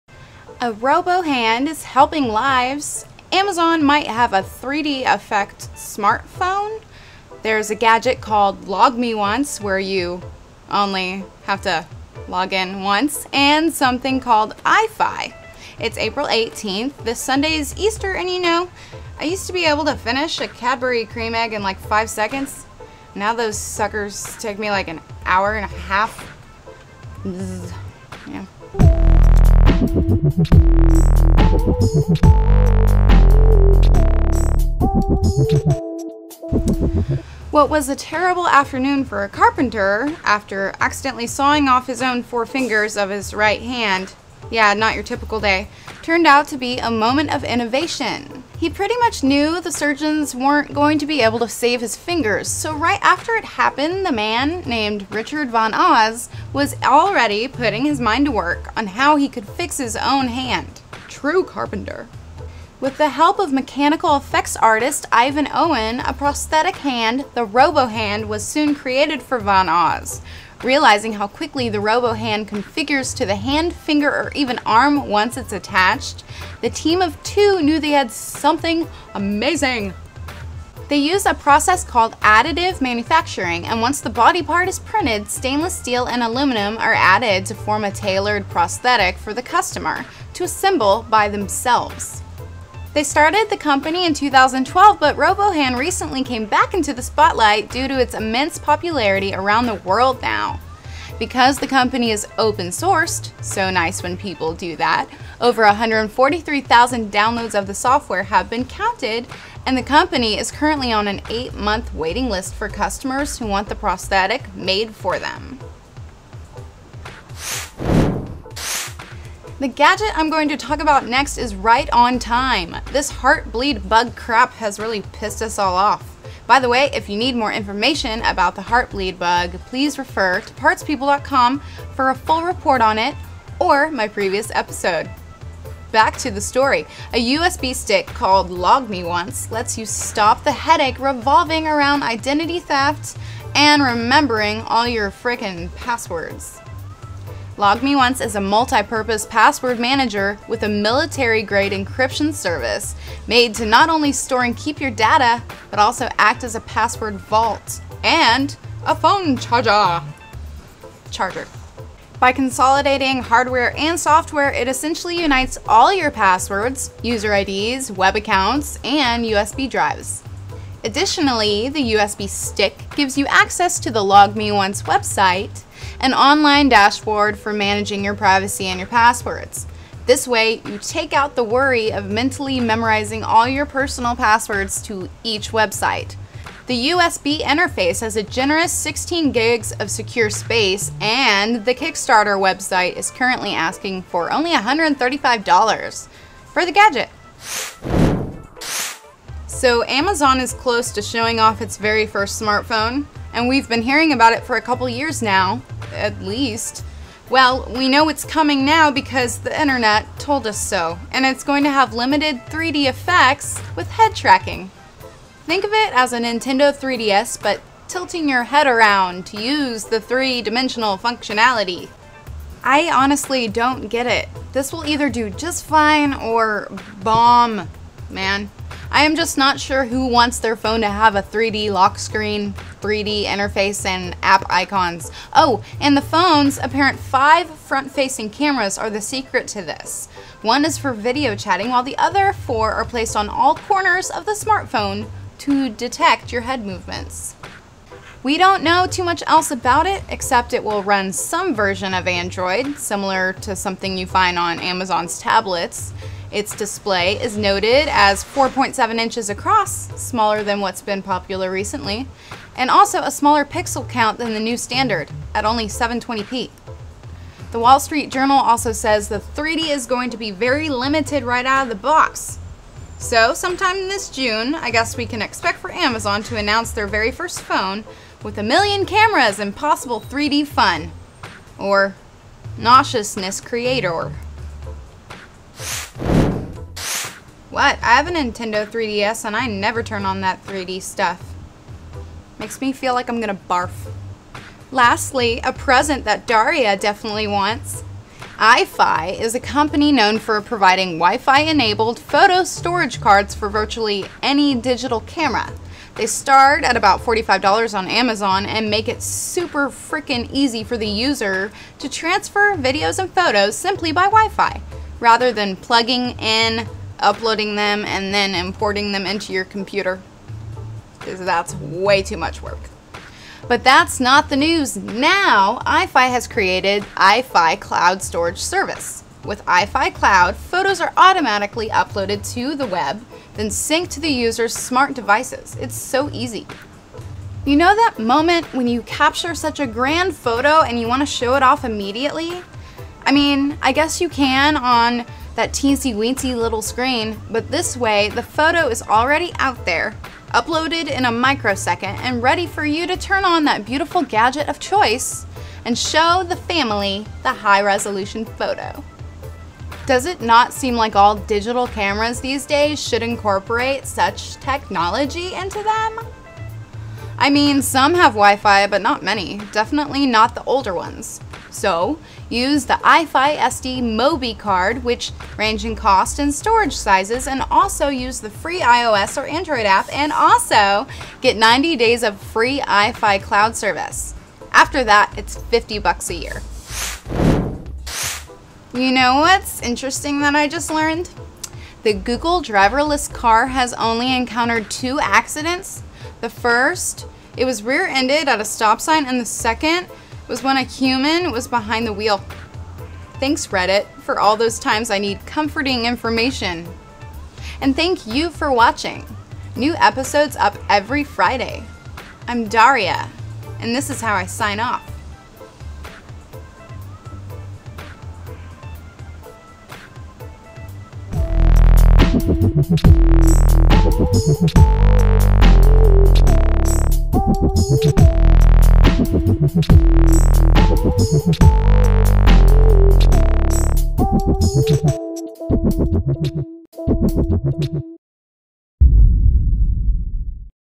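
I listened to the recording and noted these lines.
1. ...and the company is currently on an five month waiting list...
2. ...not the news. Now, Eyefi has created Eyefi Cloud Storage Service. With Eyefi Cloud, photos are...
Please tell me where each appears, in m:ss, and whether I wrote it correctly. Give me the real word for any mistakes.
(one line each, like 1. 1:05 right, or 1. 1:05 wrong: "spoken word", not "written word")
1. 1:49 wrong: "eight", not "five"
2. 5:23 right.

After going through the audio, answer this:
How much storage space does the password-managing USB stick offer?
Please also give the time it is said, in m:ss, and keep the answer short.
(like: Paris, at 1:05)
16 gigs, at 3:08.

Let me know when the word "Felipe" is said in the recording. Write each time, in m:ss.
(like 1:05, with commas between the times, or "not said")
not said.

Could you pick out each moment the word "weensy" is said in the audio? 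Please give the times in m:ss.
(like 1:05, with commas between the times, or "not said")
5:45.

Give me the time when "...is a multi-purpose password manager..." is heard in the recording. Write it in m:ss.
2:28.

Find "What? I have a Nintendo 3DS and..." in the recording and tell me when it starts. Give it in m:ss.
4:47.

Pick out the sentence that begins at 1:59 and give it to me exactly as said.
The gadget I'm going to talk about next is right on time.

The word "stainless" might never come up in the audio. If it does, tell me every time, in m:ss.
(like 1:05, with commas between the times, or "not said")
1:25.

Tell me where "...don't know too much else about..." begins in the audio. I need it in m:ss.
4:08.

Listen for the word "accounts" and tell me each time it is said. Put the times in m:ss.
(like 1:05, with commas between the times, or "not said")
2:48.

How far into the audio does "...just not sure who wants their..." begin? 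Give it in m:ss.
3:49.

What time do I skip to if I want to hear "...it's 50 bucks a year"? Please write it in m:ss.
6:25.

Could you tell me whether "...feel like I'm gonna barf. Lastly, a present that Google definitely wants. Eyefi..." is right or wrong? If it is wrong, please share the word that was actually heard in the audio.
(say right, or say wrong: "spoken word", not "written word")
wrong: "Daria", not "Google".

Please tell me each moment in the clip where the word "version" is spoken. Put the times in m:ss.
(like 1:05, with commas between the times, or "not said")
4:11.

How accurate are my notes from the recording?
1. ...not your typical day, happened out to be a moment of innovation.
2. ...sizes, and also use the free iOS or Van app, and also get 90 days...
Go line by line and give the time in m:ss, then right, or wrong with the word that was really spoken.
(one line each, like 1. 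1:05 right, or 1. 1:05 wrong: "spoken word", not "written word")
1. 0:44 wrong: "turned", not "happened"
2. 6:16 wrong: "Android", not "Van".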